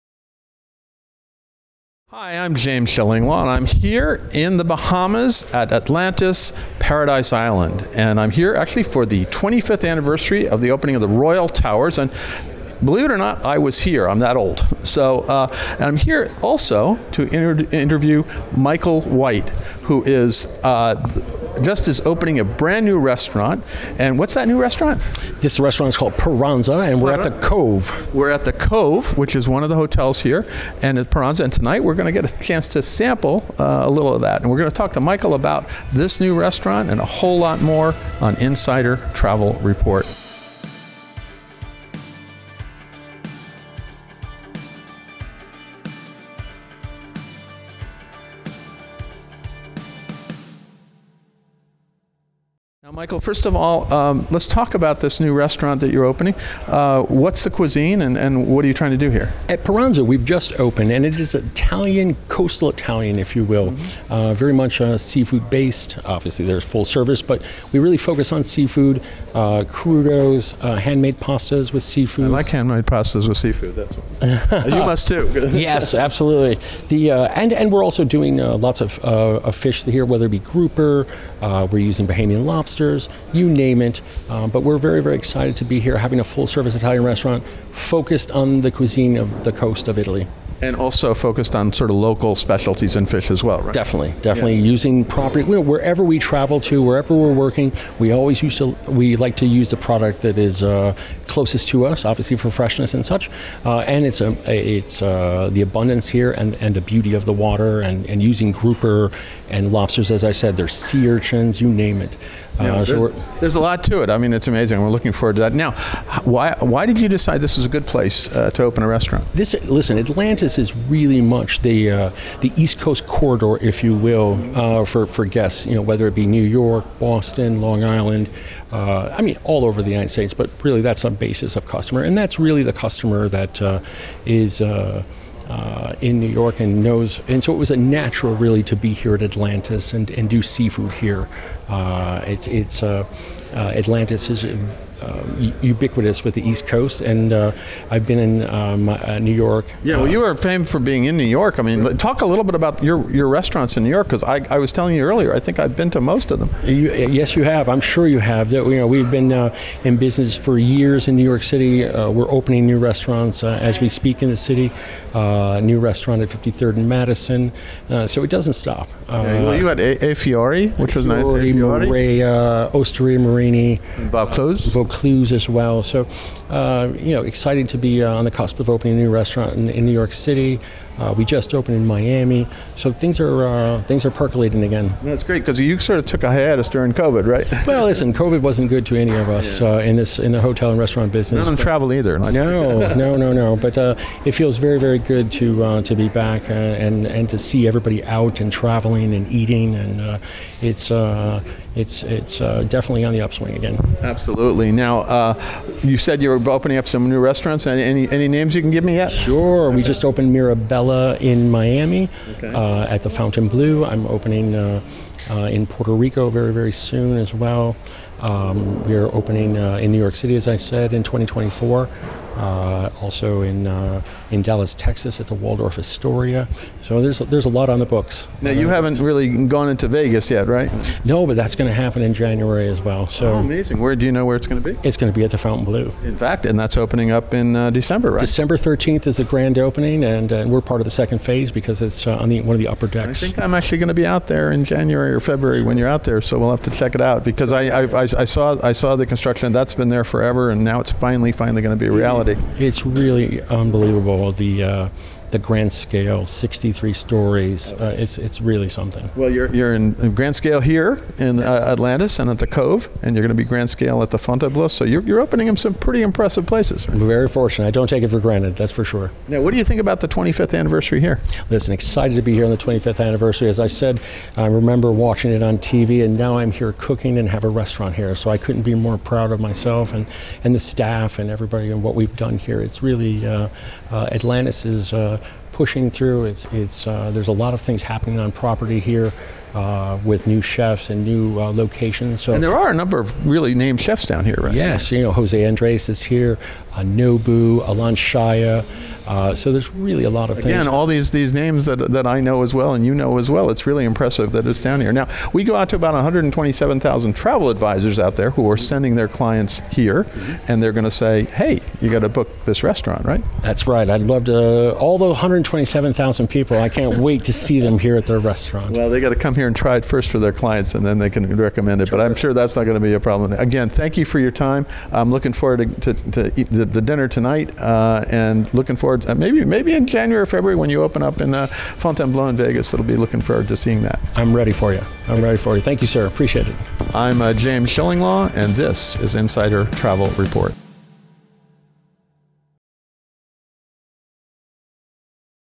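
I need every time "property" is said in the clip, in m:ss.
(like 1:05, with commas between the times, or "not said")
1:35, 4:48.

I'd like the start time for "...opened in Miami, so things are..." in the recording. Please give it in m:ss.
3:01.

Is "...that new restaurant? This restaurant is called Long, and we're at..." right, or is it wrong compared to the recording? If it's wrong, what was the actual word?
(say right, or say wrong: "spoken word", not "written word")
wrong: "Paranza", not "Long".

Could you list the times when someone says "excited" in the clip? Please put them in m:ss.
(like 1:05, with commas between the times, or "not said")
1:25, 2:57, 4:31.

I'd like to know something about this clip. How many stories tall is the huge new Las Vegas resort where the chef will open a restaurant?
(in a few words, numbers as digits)
63.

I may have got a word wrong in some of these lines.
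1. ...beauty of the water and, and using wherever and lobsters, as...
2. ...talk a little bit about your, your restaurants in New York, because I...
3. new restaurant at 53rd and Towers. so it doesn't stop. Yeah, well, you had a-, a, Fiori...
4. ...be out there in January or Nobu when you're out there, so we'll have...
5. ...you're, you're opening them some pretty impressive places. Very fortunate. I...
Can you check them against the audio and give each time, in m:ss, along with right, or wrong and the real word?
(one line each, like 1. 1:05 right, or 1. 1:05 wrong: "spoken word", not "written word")
1. 1:46 wrong: "grouper", not "wherever"
2. 2:31 right
3. 2:45 wrong: "Madison", not "Towers"
4. 4:03 wrong: "February", not "Nobu"
5. 4:24 right.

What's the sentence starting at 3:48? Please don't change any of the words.
Now you haven't really gone into Vegas yet, right?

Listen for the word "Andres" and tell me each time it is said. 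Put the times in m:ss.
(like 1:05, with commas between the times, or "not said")
4:55.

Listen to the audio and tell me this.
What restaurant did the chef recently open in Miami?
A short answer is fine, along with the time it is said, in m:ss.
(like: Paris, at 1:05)
Mirabella, at 3:30.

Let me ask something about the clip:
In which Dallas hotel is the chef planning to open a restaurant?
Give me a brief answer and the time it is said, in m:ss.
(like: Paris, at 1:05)
Waldorf Astoria, at 3:45.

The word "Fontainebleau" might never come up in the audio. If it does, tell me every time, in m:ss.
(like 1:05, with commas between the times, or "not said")
3:33, 4:24, 5:31.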